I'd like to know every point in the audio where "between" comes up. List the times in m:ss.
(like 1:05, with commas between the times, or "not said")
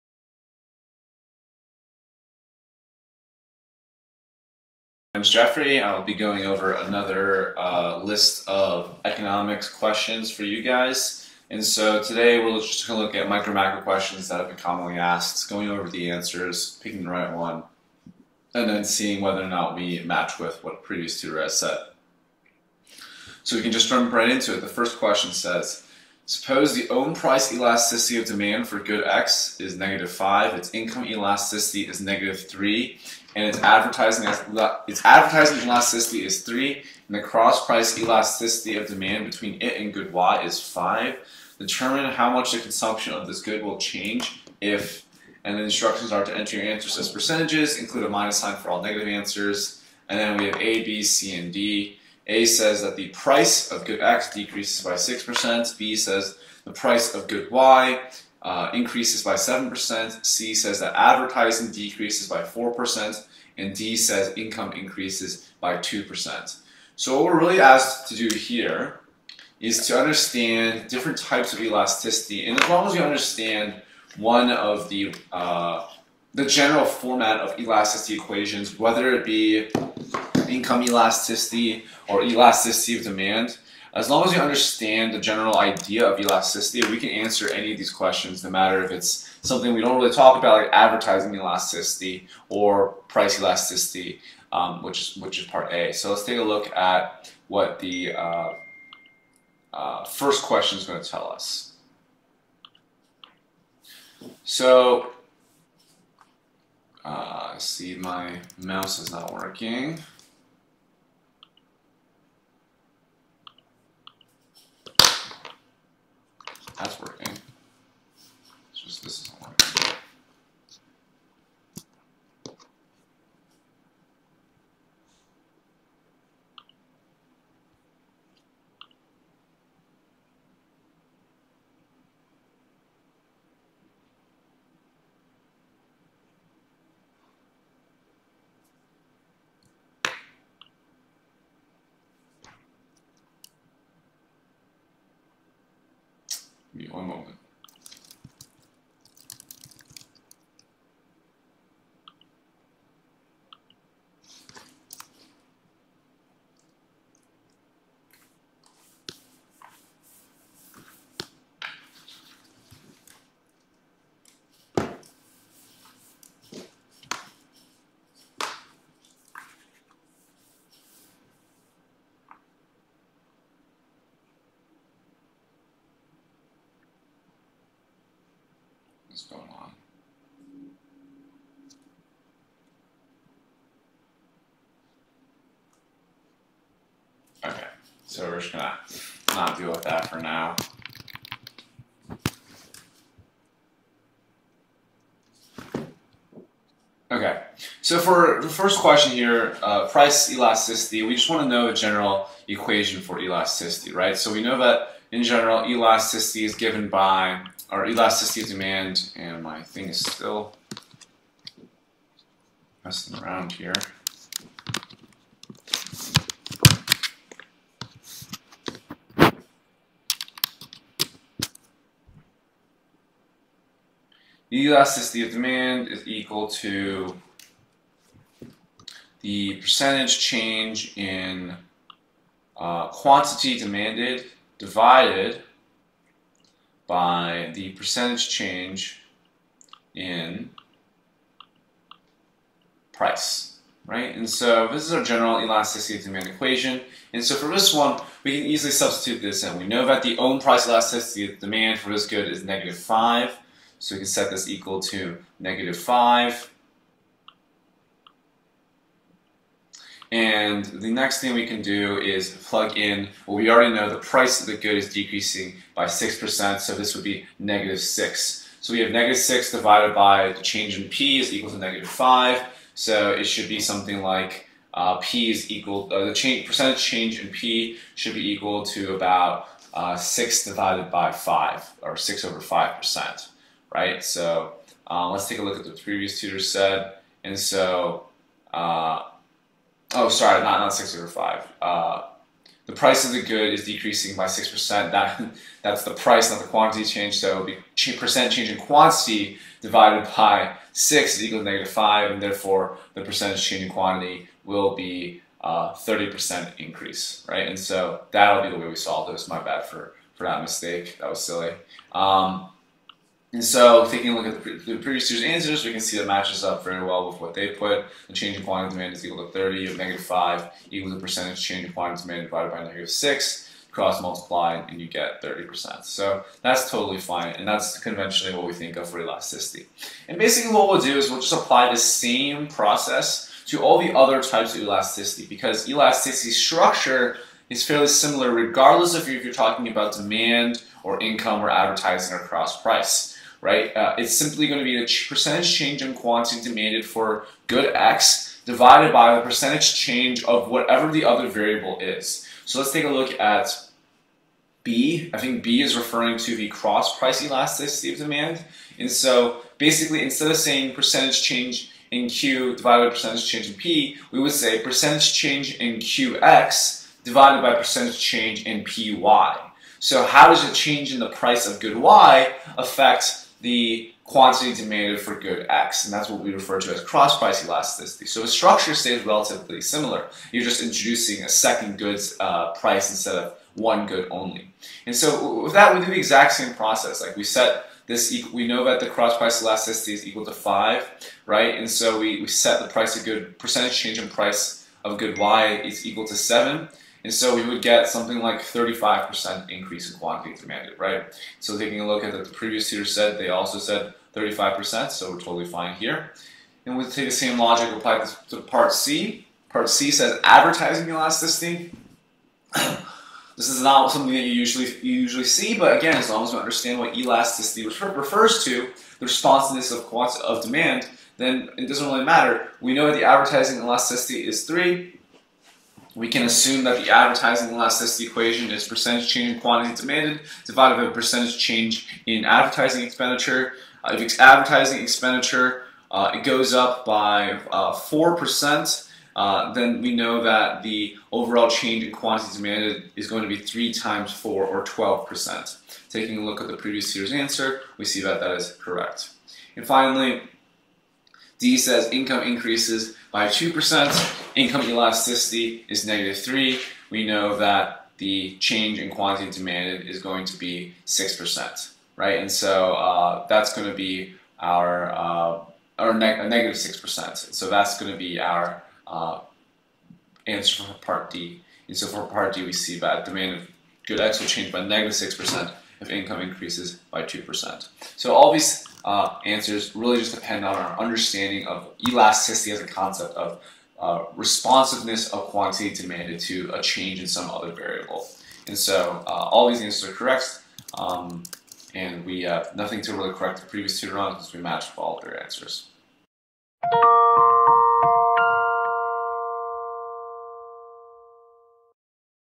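0:39.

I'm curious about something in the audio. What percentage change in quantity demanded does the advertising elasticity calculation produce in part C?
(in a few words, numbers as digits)
12%.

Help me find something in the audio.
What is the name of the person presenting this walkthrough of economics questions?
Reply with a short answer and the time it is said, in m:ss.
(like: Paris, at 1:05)
Jeffrey, at 0:05.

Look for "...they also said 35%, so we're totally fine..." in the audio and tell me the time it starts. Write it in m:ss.
6:43.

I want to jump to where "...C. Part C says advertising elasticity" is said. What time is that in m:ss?
6:48.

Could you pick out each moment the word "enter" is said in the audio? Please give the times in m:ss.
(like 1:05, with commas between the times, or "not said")
0:46.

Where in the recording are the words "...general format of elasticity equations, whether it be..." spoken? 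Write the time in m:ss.
1:16.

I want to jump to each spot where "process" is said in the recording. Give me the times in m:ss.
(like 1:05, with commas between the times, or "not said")
5:32, 6:26.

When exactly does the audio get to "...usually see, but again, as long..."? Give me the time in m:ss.
6:55.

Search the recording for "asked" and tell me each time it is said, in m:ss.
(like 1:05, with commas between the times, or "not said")
0:14, 1:07.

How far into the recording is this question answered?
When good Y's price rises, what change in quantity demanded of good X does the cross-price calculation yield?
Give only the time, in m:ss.
6:38.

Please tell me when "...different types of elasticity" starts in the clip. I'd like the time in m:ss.
1:10.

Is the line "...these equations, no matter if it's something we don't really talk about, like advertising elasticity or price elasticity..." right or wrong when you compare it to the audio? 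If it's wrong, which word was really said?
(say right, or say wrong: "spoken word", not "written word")
wrong: "questions", not "equations".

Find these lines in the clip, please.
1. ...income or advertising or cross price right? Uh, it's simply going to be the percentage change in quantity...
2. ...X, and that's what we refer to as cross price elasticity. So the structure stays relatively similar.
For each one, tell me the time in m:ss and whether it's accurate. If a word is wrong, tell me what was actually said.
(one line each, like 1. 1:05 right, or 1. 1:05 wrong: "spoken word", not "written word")
1. 5:41 right
2. 6:15 right.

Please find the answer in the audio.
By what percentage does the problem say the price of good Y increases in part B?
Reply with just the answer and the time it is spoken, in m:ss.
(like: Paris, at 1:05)
7%, at 0:58.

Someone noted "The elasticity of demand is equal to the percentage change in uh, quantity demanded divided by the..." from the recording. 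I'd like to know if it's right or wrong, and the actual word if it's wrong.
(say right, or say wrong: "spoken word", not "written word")
right.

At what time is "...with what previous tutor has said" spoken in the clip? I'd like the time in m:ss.
0:20.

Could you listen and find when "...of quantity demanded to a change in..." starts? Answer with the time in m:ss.
8:05.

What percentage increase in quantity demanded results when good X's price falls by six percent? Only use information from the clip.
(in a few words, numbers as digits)
30%.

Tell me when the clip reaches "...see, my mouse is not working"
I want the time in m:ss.
1:47.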